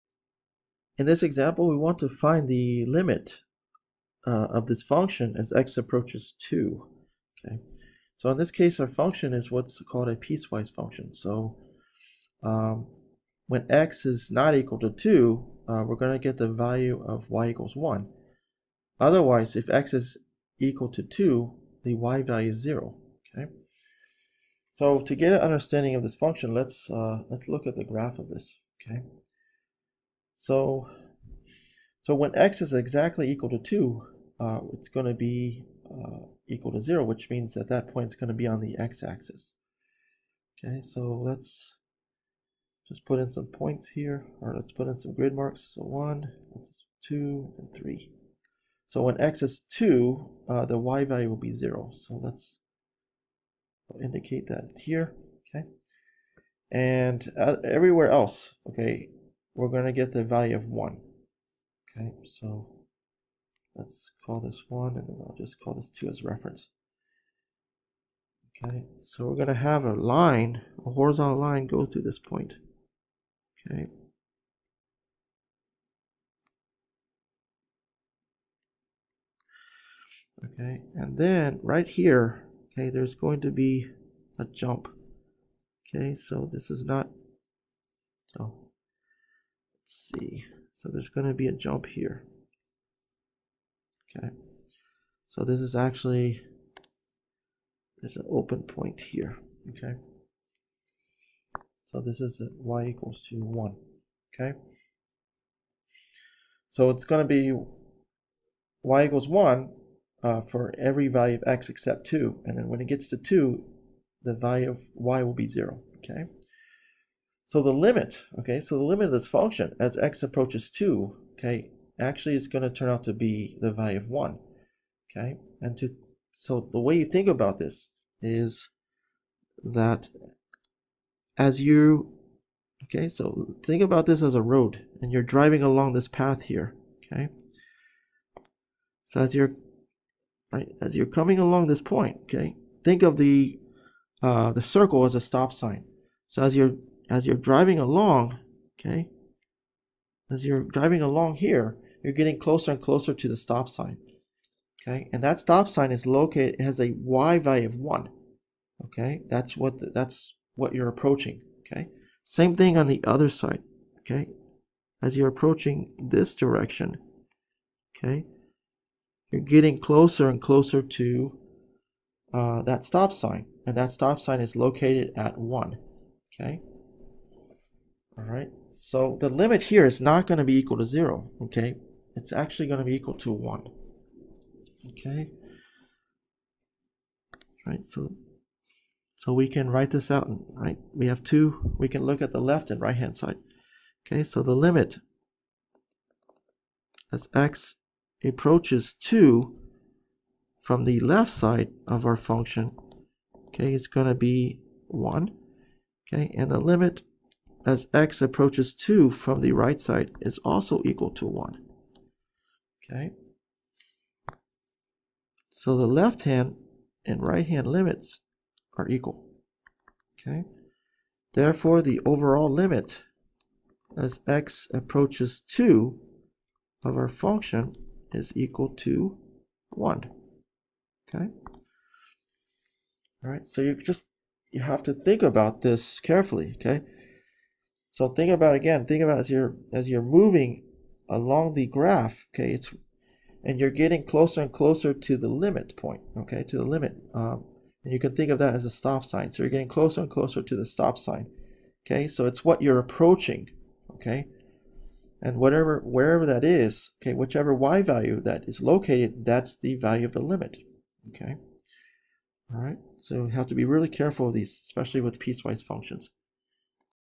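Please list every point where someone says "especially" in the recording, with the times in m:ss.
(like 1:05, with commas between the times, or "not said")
4:24.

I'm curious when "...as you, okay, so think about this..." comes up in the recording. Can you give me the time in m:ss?
2:11.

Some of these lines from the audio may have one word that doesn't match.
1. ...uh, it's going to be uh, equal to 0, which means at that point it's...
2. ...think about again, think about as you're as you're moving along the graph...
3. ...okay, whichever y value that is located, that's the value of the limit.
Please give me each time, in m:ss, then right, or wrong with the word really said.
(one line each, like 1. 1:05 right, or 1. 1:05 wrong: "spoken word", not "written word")
1. 0:34 right
2. 3:58 right
3. 4:17 right.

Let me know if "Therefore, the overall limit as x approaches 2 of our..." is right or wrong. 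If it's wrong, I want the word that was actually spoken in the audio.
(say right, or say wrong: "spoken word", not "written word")
right.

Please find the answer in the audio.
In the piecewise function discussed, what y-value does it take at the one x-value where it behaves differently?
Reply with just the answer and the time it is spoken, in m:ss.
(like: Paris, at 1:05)
0, at 0:21.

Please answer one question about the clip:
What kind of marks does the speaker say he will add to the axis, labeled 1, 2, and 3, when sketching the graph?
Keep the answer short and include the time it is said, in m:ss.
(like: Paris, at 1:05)
grid marks, at 0:45.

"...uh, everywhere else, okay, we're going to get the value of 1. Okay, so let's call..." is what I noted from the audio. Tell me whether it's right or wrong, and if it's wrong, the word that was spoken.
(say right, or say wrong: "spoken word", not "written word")
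right.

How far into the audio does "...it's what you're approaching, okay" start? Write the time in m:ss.
4:12.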